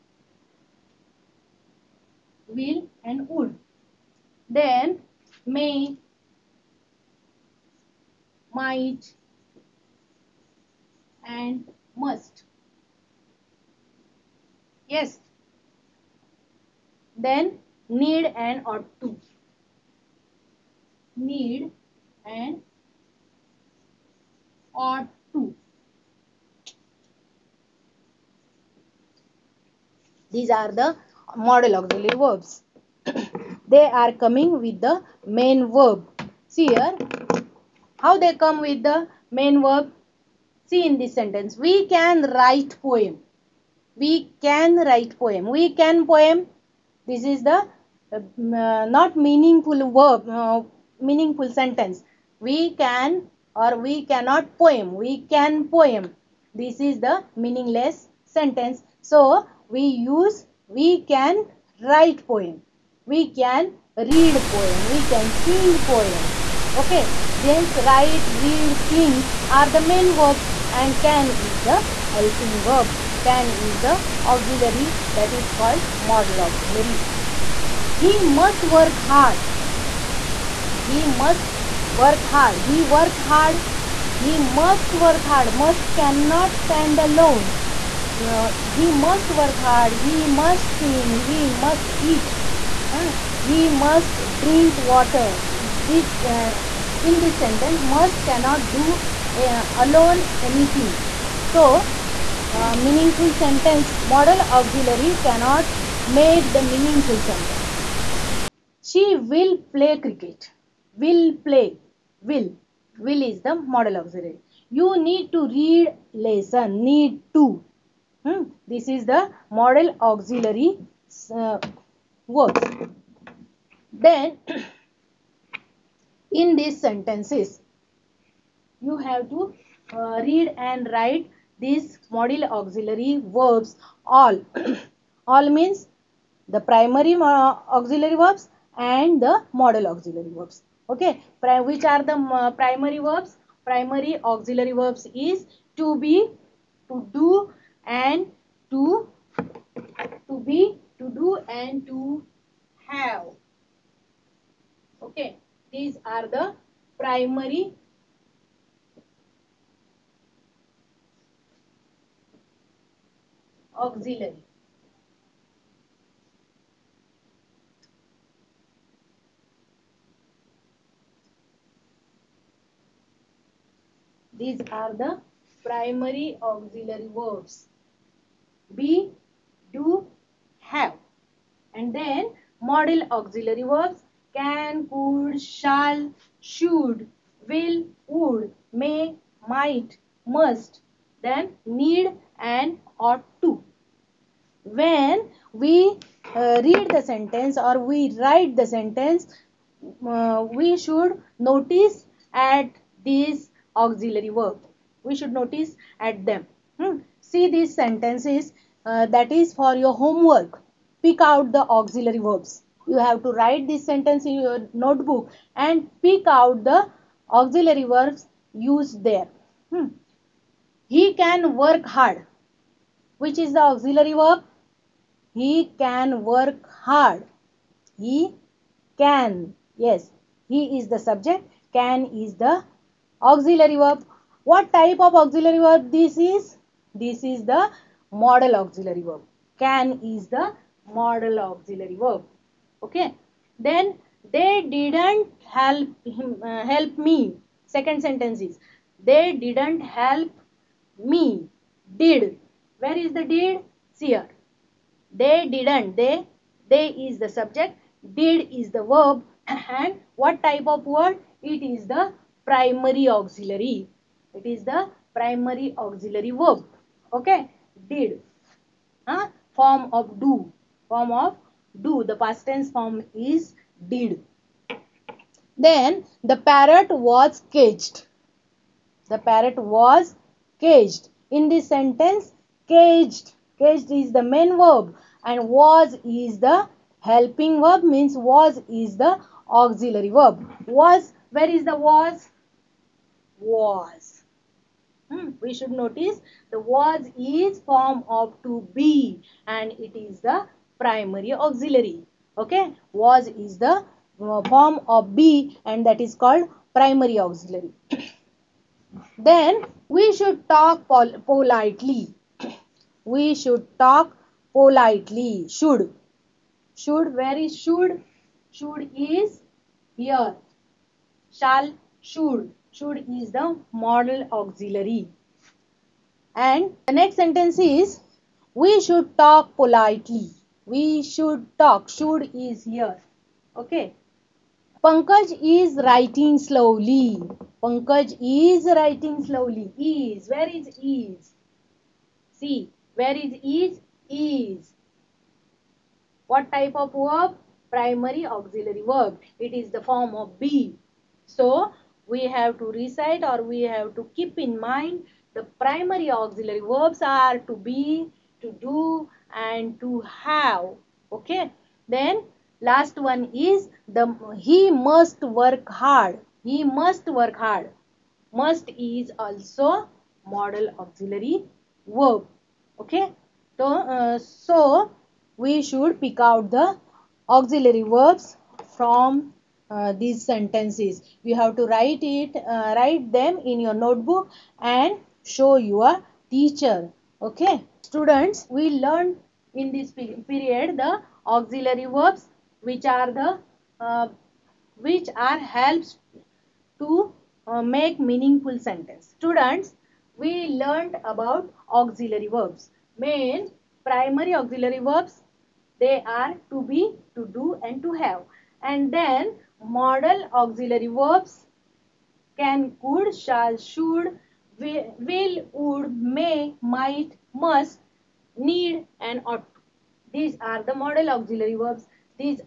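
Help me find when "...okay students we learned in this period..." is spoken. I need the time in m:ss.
6:27.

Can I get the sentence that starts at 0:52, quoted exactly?
We can or we cannot poem.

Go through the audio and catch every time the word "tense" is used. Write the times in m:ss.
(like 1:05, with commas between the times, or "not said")
4:32.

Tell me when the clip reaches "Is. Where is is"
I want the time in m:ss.
5:39.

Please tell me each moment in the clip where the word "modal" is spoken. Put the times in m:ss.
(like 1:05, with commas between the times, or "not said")
1:15, 1:53, 1:59, 2:12, 2:19, 5:23, 6:49, 7:00.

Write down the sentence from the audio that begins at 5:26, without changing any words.
And the next sentence is we should talk politely.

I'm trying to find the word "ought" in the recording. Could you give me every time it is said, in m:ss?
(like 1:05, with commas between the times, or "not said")
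0:18, 0:24, 3:12, 6:59.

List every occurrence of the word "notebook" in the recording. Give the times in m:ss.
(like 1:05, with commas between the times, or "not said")
3:34, 6:23.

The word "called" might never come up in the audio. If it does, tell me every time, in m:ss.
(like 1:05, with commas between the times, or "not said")
1:15, 5:06.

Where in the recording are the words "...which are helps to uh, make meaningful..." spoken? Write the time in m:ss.
6:34.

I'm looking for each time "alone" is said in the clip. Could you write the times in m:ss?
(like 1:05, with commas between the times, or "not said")
1:27, 1:39.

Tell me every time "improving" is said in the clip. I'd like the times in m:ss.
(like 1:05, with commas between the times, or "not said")
not said.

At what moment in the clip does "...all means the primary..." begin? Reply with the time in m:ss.
2:15.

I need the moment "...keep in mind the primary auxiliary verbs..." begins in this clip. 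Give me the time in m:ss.
5:54.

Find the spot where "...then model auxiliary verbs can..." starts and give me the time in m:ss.
3:01.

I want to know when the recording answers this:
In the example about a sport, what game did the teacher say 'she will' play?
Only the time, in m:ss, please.
1:50.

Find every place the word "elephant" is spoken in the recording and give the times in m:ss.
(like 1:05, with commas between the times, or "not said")
not said.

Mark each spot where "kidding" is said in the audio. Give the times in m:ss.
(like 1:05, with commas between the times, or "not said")
not said.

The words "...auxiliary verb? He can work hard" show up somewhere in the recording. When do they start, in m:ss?
3:43.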